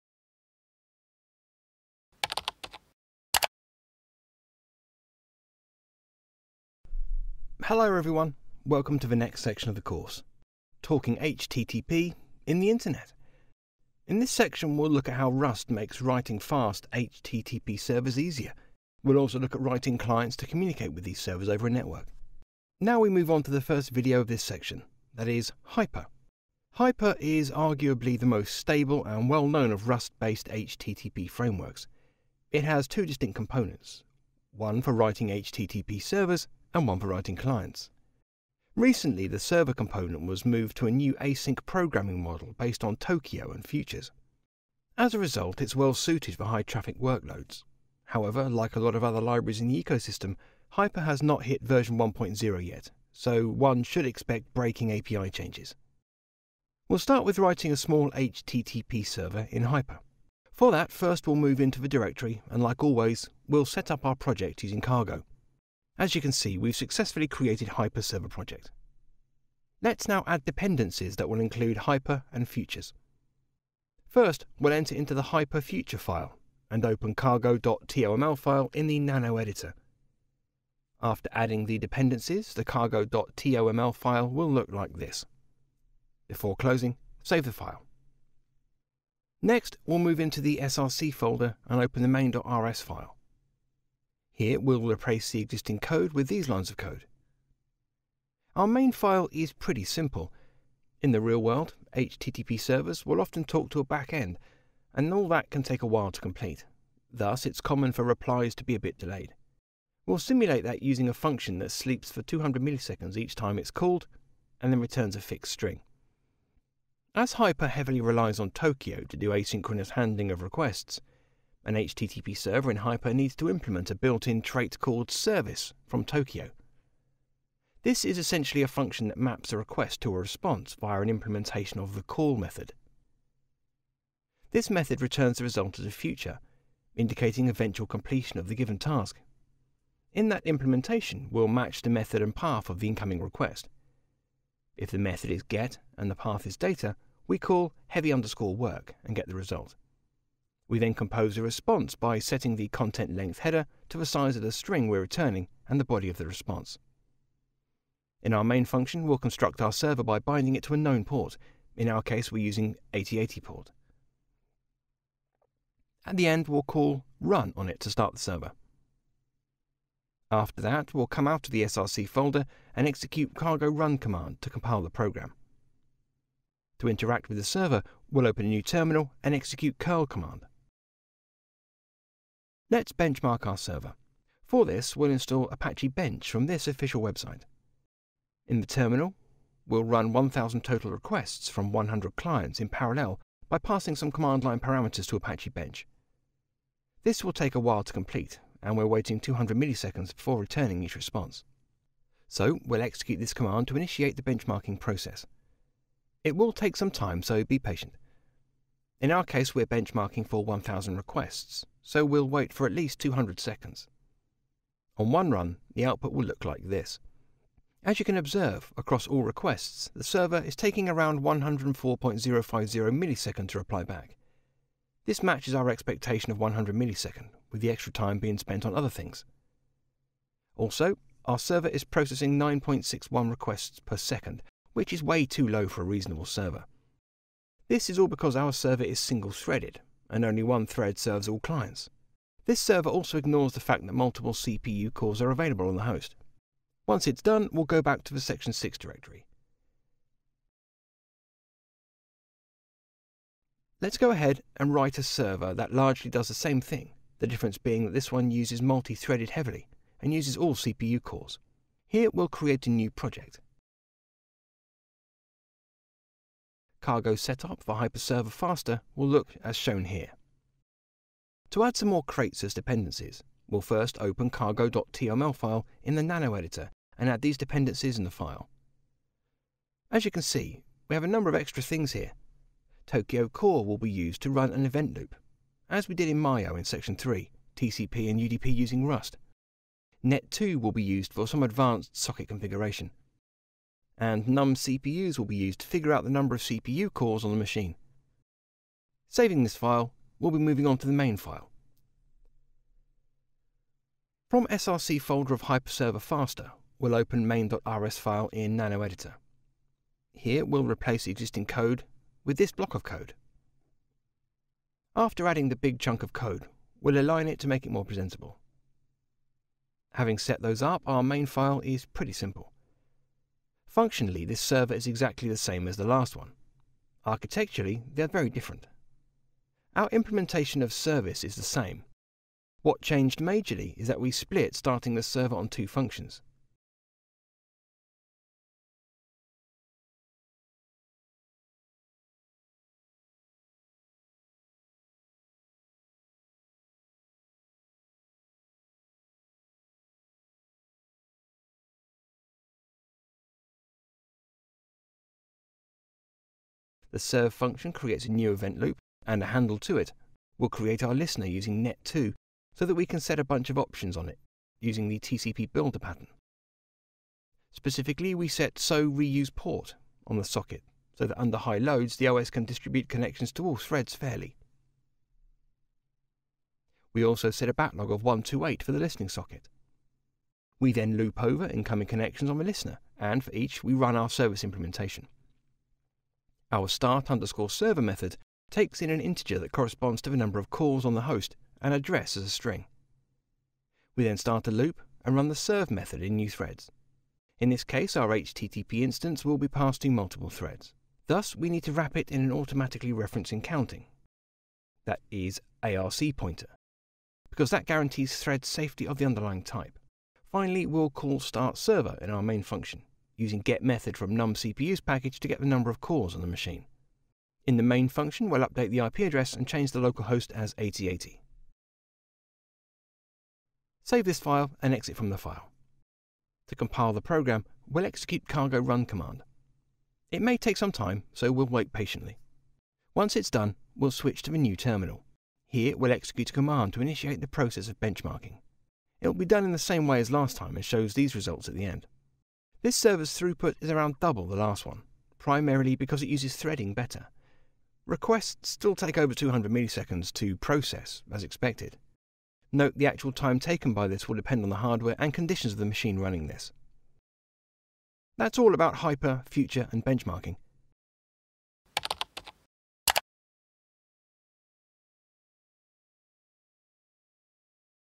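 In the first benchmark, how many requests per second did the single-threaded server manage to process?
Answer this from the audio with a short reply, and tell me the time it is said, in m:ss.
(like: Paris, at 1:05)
9.61, at 3:52.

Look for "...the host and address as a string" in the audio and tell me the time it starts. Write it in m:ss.
6:30.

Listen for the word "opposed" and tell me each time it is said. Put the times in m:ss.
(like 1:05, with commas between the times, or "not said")
not said.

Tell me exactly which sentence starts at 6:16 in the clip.
We also set a backlog of 128 for the listening socket.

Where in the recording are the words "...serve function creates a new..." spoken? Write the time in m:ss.
5:56.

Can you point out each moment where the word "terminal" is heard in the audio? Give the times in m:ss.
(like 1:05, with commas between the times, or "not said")
2:58, 3:08, 7:14.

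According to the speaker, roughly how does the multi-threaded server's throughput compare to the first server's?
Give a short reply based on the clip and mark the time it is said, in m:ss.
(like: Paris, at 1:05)
around double, at 7:23.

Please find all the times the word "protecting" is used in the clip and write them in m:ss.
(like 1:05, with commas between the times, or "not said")
not said.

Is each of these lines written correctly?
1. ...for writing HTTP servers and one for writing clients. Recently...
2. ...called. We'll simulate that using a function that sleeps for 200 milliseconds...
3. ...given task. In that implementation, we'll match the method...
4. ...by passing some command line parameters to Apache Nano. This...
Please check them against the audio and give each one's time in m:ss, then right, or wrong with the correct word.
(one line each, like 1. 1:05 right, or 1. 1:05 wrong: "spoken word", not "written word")
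1. 0:34 right
2. 1:48 wrong: "delayed", not "called"
3. 2:18 right
4. 3:13 wrong: "Bench", not "Nano".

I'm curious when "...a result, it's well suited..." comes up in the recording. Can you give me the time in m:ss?
0:45.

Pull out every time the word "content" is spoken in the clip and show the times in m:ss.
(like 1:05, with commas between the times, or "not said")
2:32.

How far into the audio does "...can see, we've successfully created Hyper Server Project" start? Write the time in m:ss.
1:06.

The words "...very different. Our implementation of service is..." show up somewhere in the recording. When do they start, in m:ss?
5:28.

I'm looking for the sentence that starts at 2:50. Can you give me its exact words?
After that, we'll come out of the src folder and execute cargo run command to compile the program.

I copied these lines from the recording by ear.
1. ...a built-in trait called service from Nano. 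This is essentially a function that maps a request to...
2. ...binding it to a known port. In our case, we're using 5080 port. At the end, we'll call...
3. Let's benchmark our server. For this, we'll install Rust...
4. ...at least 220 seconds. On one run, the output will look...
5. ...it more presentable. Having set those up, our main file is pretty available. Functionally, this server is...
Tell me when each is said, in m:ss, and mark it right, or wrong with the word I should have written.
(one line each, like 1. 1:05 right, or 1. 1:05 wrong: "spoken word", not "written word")
1. 2:03 wrong: "Tokio", not "Nano"
2. 2:40 wrong: "8080", not "5080"
3. 3:02 wrong: "Apache", not "Rust"
4. 3:32 wrong: "200", not "220"
5. 5:17 wrong: "simple", not "available".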